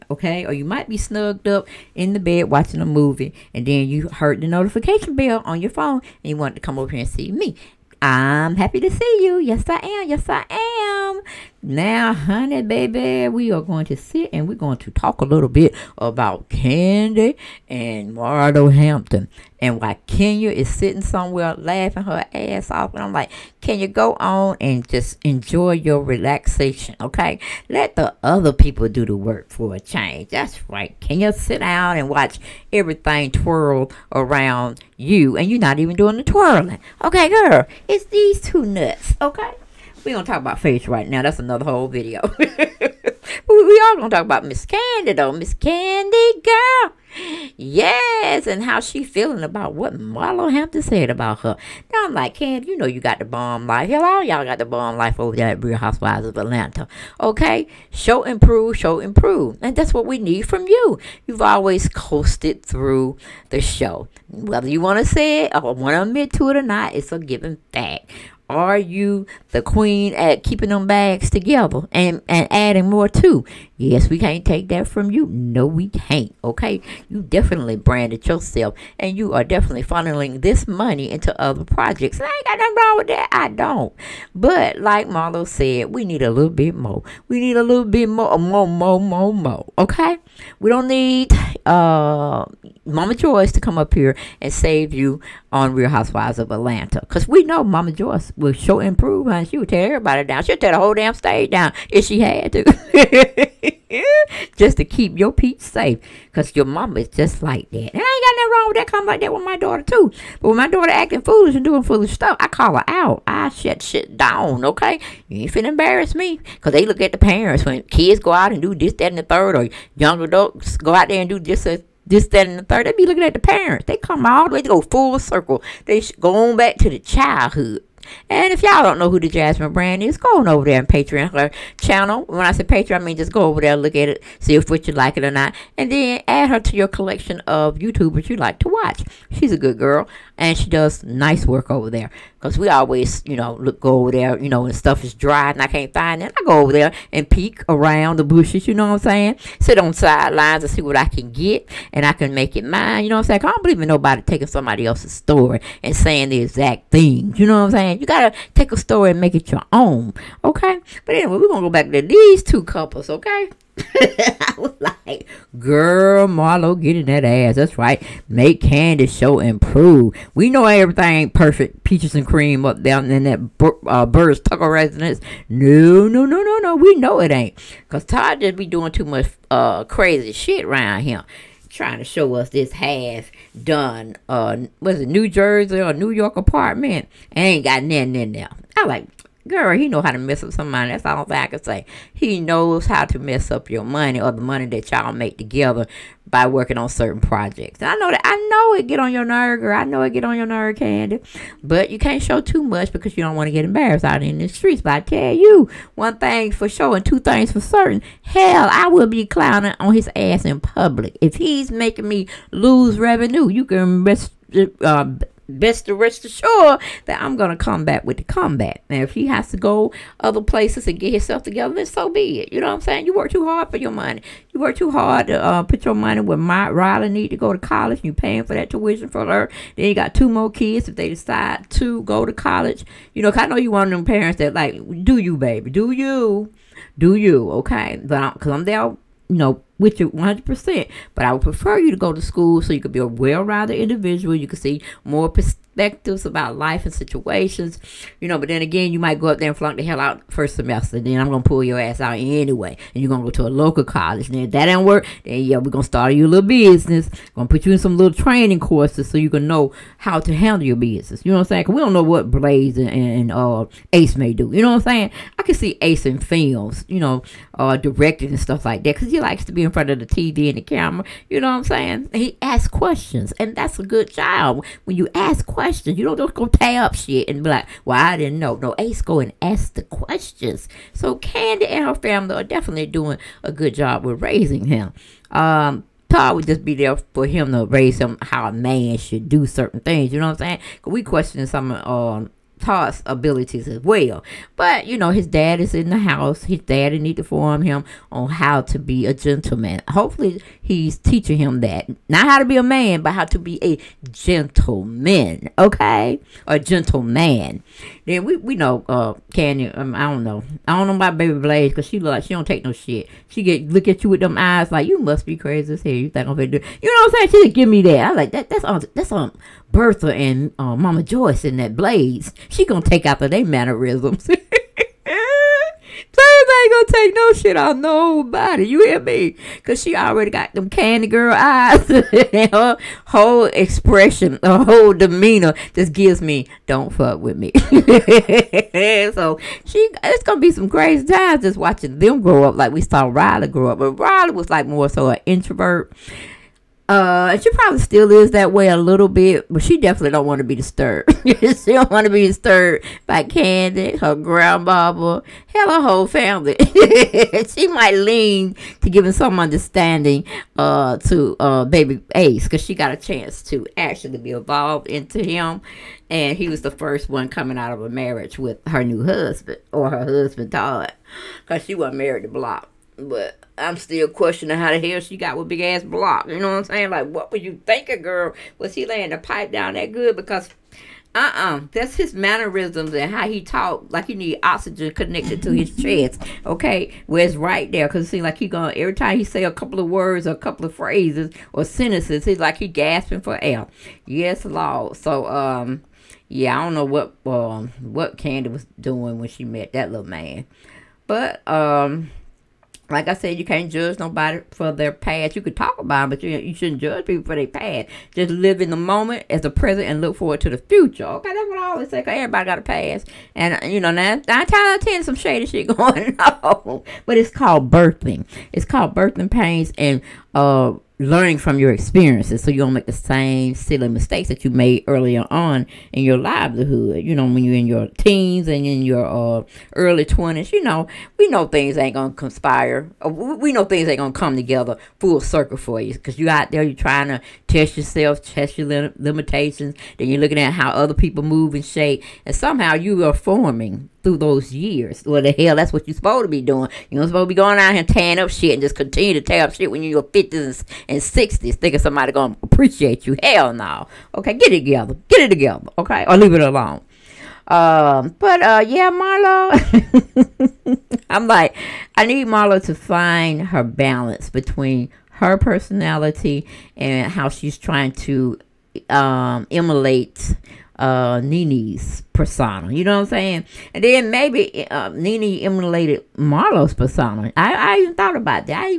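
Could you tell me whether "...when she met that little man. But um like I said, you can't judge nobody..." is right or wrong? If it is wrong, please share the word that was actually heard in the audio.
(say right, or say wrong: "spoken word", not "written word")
right.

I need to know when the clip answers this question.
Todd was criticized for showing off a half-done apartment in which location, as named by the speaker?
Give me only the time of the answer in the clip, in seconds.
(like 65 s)
185 s.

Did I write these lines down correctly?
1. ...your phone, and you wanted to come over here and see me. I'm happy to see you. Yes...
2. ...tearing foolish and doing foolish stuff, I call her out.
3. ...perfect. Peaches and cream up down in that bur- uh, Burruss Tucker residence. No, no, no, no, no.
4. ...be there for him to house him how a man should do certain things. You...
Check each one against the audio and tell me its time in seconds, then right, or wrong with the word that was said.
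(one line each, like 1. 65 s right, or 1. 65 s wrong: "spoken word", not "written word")
1. 5 s right
2. 110 s wrong: "acting", not "tearing"
3. 171 s right
4. 286 s wrong: "raise", not "house".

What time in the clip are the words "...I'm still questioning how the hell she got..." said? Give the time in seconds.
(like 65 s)
373 s.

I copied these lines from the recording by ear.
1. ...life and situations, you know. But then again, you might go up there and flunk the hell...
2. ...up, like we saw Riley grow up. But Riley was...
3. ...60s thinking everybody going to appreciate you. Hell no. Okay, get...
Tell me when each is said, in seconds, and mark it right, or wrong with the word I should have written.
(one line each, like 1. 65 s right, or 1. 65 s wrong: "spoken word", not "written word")
1. 246 s right
2. 342 s right
3. 451 s wrong: "somebody", not "everybody".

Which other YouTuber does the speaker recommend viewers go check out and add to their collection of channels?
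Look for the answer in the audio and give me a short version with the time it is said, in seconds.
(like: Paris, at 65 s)
The Jasmine Brand, at 129 s.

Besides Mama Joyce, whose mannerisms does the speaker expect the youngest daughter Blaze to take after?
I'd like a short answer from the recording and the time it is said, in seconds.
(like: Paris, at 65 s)
Bertha, at 319 s.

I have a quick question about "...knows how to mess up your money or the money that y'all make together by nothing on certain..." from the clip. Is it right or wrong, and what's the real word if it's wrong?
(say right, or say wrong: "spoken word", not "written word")
wrong: "working", not "nothing".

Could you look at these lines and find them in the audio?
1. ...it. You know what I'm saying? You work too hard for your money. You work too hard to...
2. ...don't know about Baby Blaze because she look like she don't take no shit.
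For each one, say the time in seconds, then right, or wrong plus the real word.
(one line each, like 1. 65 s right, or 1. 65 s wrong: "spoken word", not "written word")
1. 222 s right
2. 310 s right.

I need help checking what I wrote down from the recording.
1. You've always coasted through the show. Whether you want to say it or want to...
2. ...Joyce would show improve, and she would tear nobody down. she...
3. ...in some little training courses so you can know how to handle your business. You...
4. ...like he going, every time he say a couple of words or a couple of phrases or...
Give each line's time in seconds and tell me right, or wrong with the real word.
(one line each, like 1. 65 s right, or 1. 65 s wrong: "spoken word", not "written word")
1. 61 s right
2. 97 s wrong: "everybody", not "nobody"
3. 257 s right
4. 388 s right.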